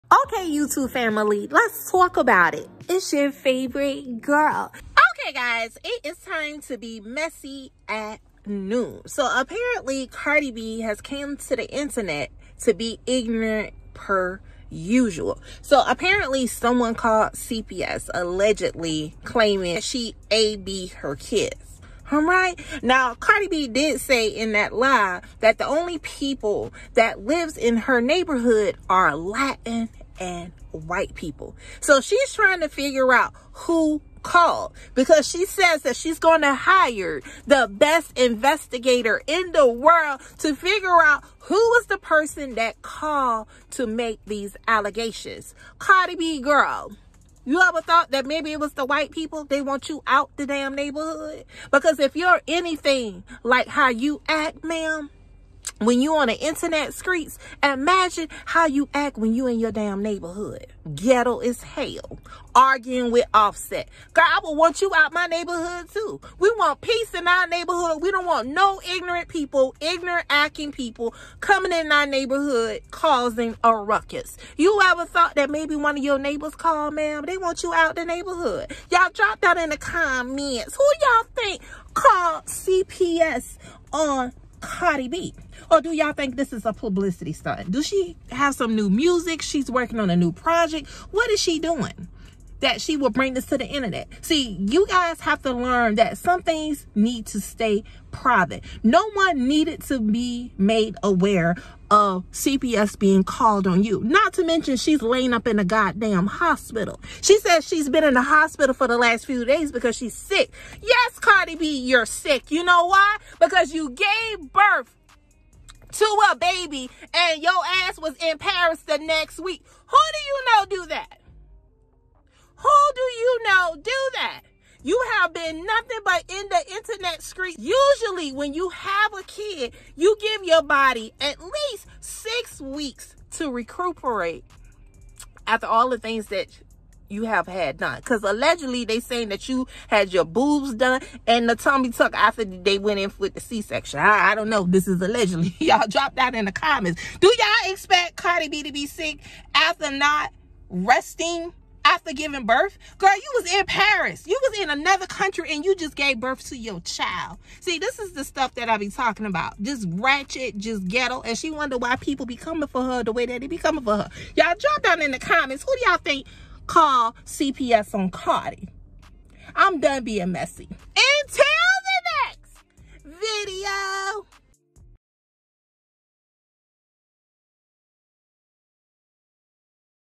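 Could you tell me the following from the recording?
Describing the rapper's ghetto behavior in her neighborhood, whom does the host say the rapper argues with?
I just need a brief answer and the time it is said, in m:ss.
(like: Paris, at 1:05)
Offset, at 1:03.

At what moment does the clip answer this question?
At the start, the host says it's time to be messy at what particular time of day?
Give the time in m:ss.
0:08.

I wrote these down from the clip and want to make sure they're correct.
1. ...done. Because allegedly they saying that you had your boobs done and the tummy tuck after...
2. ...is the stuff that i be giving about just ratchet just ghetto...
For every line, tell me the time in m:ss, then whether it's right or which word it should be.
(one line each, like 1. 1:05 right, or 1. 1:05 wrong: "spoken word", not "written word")
1. 2:17 right
2. 2:37 wrong: "talking", not "giving".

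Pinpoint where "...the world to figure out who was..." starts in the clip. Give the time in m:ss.
0:39.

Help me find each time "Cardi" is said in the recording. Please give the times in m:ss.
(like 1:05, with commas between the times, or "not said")
0:10, 0:23, 0:45, 1:24, 1:51, 2:28, 2:48.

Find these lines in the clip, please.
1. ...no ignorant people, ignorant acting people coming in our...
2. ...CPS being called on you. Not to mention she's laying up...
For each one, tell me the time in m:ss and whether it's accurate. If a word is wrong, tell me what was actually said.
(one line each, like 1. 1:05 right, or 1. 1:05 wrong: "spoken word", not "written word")
1. 1:08 right
2. 1:42 right.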